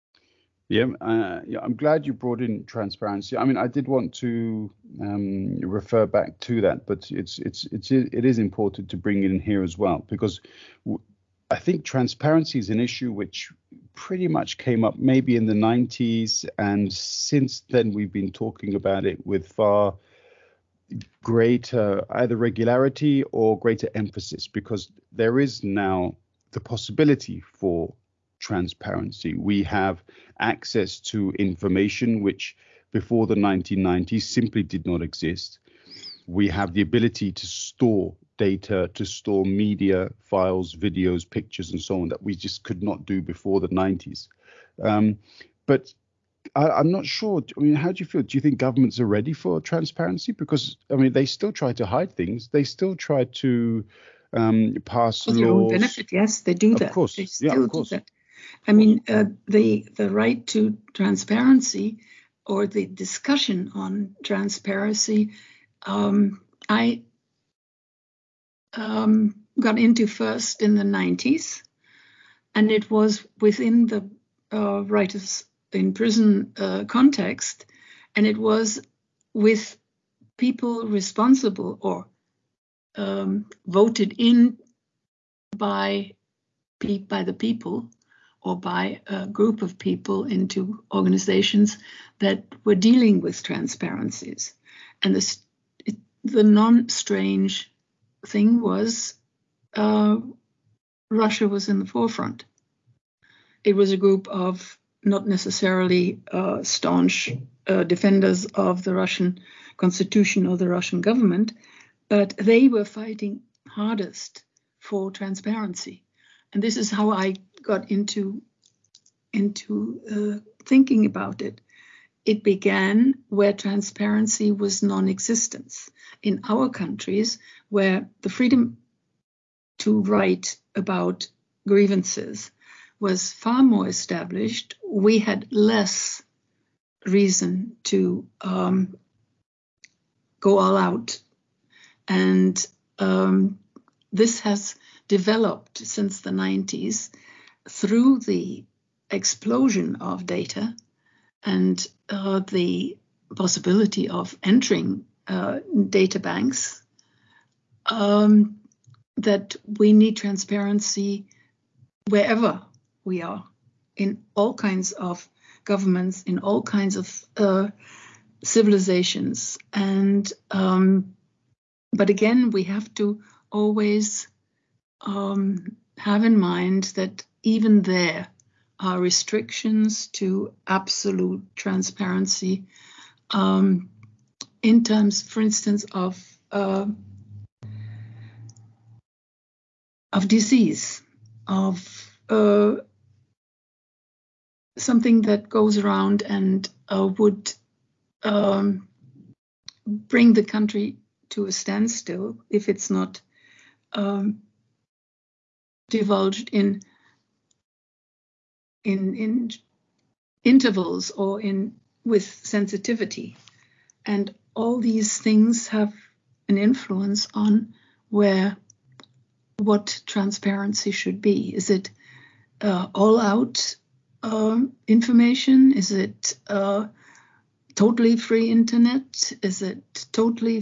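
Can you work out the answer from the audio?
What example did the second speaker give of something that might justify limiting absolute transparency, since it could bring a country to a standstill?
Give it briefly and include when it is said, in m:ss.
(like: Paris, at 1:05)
disease, at 3:10.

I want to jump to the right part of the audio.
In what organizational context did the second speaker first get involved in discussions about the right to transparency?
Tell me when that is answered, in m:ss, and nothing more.
1:14.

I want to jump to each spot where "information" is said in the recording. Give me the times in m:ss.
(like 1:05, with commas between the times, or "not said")
0:31, 3:44.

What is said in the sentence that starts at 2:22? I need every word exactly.
And um, this has developed since the 90s through the explosion of data and uh, the possibility of entering uh, data banks.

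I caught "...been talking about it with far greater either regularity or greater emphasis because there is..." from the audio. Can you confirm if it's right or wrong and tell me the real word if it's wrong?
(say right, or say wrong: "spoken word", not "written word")
right.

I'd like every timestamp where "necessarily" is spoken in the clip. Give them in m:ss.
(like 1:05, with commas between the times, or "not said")
1:45.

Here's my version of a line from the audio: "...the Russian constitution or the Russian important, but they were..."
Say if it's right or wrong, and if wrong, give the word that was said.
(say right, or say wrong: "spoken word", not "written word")
wrong: "government", not "important".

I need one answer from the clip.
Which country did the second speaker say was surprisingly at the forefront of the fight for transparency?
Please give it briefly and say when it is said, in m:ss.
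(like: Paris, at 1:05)
Russia, at 1:41.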